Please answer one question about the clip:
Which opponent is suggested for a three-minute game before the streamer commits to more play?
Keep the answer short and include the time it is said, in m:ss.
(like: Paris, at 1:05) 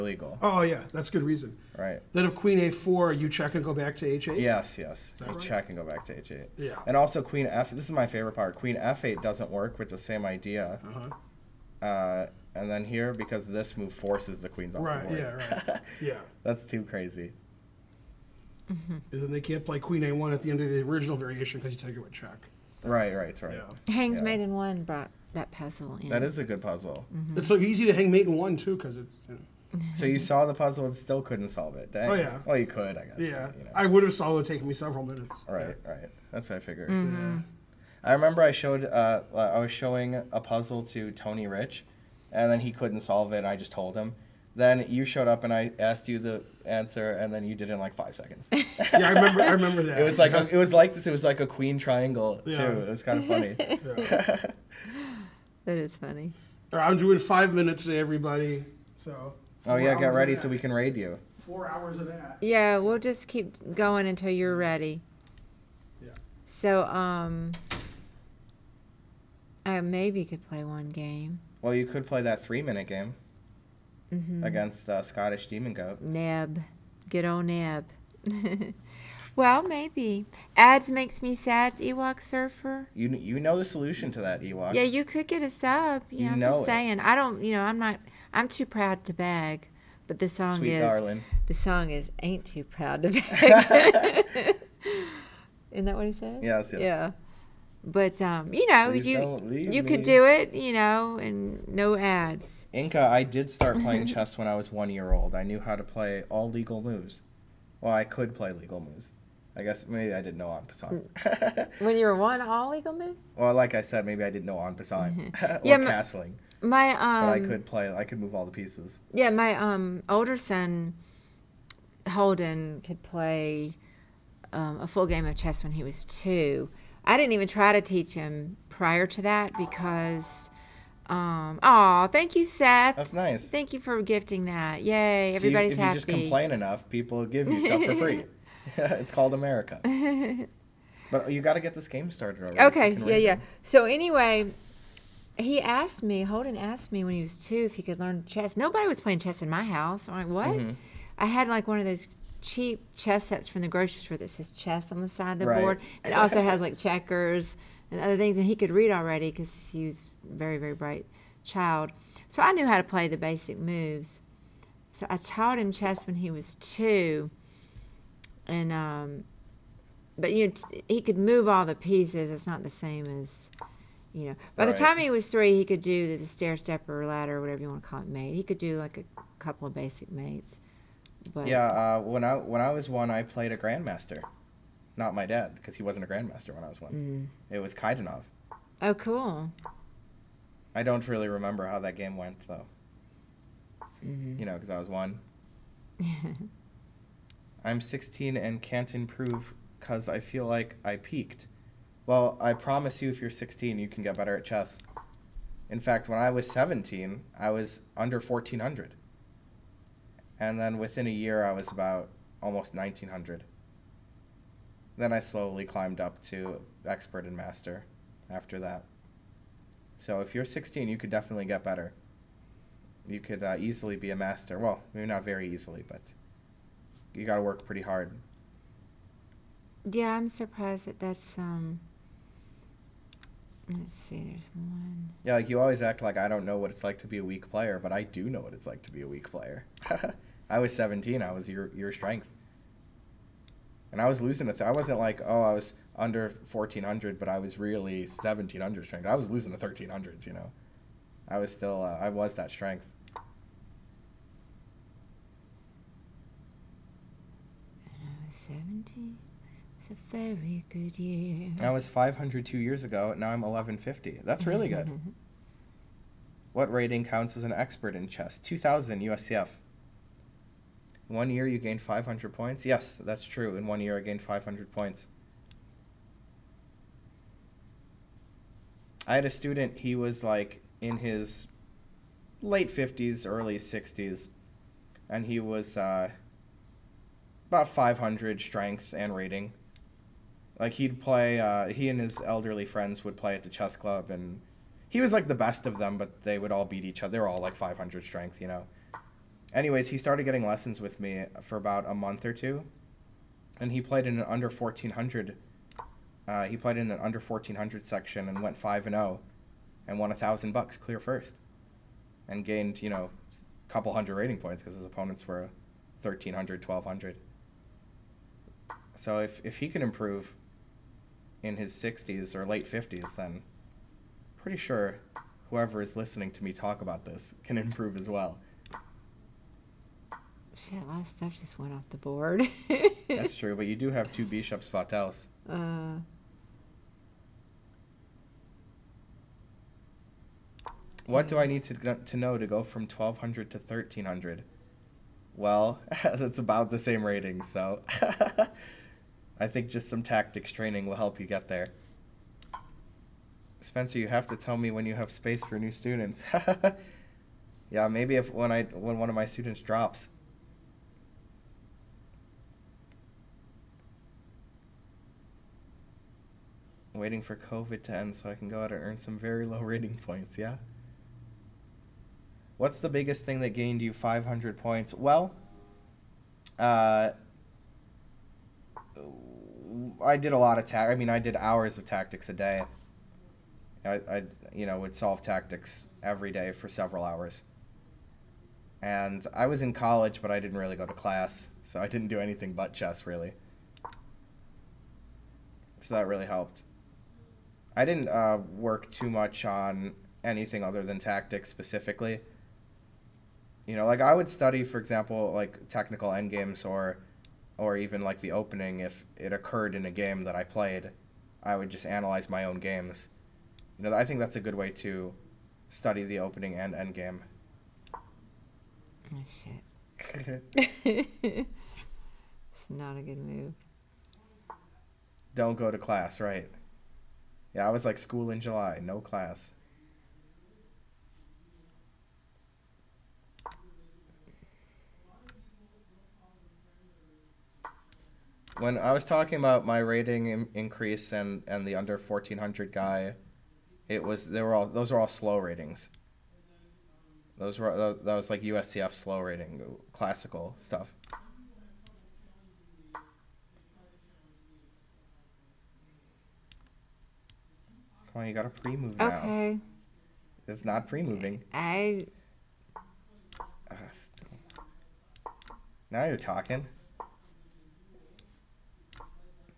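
Scottish Demon Goat, at 1:15.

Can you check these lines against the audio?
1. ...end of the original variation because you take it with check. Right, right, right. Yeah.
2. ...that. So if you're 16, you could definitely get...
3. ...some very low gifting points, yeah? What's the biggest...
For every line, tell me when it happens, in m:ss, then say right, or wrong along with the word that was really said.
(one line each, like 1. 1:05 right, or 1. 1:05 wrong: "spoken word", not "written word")
1. 0:20 right
2. 3:38 right
3. 6:08 wrong: "rating", not "gifting".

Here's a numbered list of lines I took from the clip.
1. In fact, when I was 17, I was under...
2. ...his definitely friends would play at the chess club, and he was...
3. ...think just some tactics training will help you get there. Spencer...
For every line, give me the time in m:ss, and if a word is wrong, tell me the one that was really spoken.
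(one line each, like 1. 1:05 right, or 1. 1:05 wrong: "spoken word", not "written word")
1. 3:25 right
2. 4:51 wrong: "elderly", not "definitely"
3. 5:49 right.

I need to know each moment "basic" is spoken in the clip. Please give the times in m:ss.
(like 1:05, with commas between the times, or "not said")
2:43, 2:59.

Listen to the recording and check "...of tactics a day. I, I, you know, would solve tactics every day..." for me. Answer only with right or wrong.
right.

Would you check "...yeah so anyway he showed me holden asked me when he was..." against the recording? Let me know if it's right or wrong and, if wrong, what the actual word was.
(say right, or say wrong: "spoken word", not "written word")
wrong: "asked", not "showed".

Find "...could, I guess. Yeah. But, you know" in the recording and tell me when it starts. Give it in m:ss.
0:32.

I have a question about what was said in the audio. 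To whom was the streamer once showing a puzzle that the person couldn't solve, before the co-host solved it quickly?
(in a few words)
Tony Rich.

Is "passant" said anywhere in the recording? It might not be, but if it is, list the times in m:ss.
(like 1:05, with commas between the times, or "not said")
1:50, 1:54.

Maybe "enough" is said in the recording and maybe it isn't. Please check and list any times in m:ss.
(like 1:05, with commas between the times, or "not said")
2:16.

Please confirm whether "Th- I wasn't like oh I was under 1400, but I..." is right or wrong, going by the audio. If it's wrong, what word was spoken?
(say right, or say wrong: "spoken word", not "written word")
right.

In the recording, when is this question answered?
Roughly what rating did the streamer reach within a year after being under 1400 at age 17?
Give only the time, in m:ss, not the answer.
3:32.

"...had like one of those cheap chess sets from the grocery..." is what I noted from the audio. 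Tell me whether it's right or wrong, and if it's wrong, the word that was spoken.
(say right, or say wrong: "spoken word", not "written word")
right.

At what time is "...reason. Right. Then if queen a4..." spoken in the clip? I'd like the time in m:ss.
0:01.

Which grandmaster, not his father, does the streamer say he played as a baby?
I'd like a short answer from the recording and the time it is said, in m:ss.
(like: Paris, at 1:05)
Kaidanov, at 3:07.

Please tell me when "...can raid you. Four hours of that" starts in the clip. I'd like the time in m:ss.
1:00.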